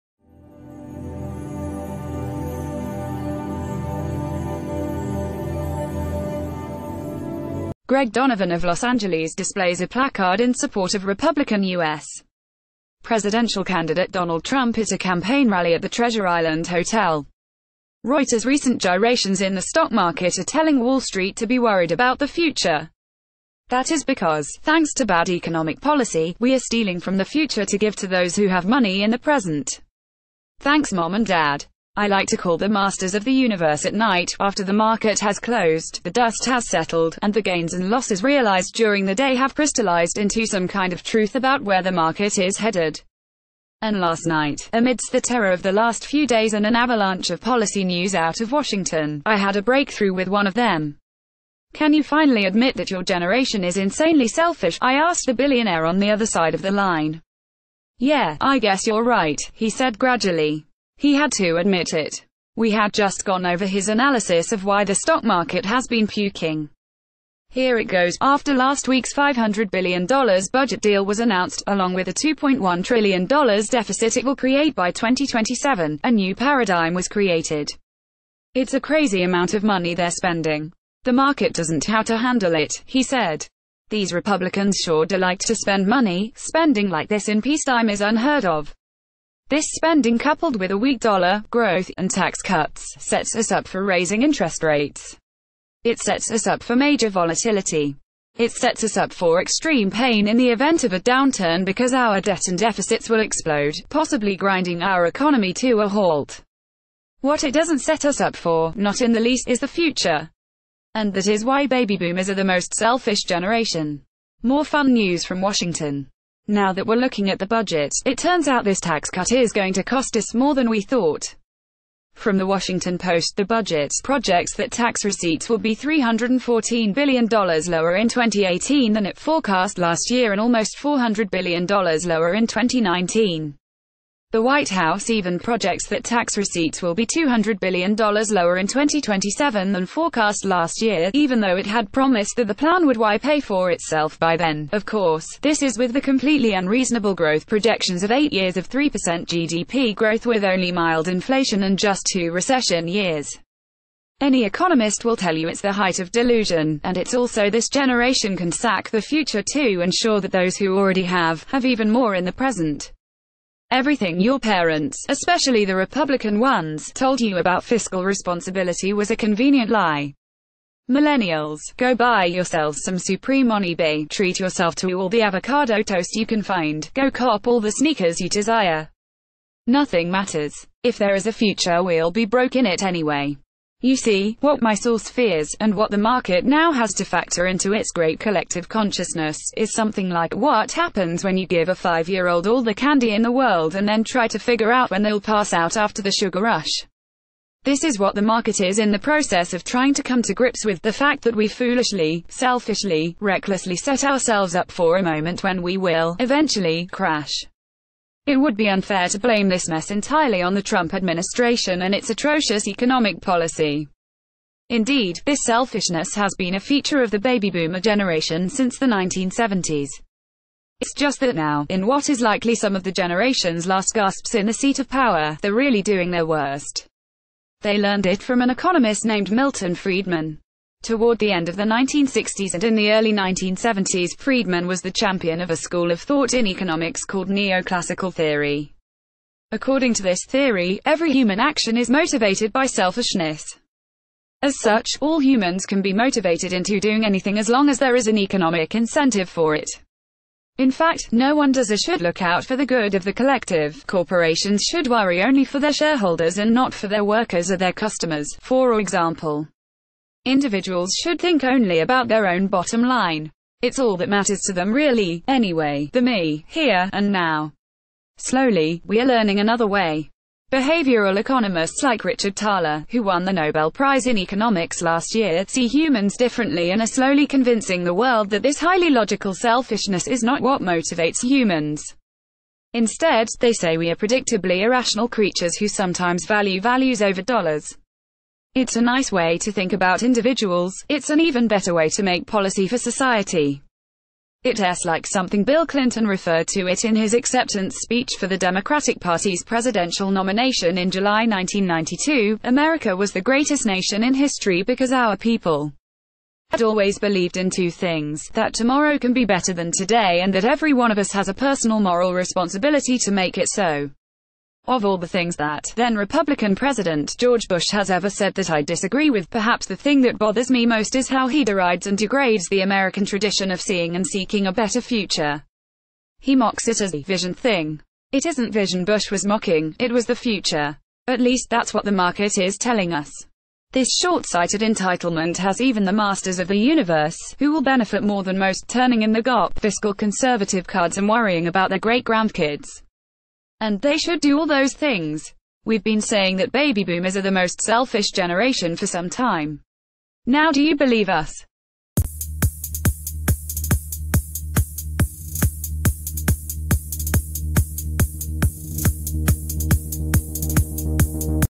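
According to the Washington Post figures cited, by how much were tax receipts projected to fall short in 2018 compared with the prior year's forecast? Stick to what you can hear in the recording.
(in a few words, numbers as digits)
$314 billion.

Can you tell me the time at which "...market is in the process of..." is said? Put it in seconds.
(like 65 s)
198 s.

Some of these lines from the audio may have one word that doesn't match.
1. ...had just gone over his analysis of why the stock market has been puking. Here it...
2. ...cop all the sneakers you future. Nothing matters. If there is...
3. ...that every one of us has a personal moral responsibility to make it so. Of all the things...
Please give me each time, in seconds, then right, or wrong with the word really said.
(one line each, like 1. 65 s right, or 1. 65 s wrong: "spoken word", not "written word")
1. 62 s right
2. 177 s wrong: "desire", not "future"
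3. 310 s right.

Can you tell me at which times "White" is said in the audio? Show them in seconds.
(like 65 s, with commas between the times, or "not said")
134 s.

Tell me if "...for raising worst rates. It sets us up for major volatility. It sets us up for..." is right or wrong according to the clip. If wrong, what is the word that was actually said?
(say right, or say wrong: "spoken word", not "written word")
wrong: "interest", not "worst".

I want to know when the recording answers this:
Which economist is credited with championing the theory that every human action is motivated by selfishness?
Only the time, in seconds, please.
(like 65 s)
229 s.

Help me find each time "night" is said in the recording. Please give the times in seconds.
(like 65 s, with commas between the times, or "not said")
33 s, 44 s.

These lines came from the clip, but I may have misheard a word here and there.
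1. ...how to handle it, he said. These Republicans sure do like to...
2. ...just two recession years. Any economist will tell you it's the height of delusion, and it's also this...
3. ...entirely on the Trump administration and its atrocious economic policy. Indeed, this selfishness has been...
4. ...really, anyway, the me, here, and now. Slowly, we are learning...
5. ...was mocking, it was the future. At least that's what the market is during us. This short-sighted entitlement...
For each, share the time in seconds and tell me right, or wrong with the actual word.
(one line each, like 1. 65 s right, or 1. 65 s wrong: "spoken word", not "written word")
1. 81 s right
2. 151 s right
3. 209 s right
4. 264 s right
5. 329 s wrong: "telling", not "during".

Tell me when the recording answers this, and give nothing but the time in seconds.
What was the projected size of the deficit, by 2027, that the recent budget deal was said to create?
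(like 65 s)
72 s.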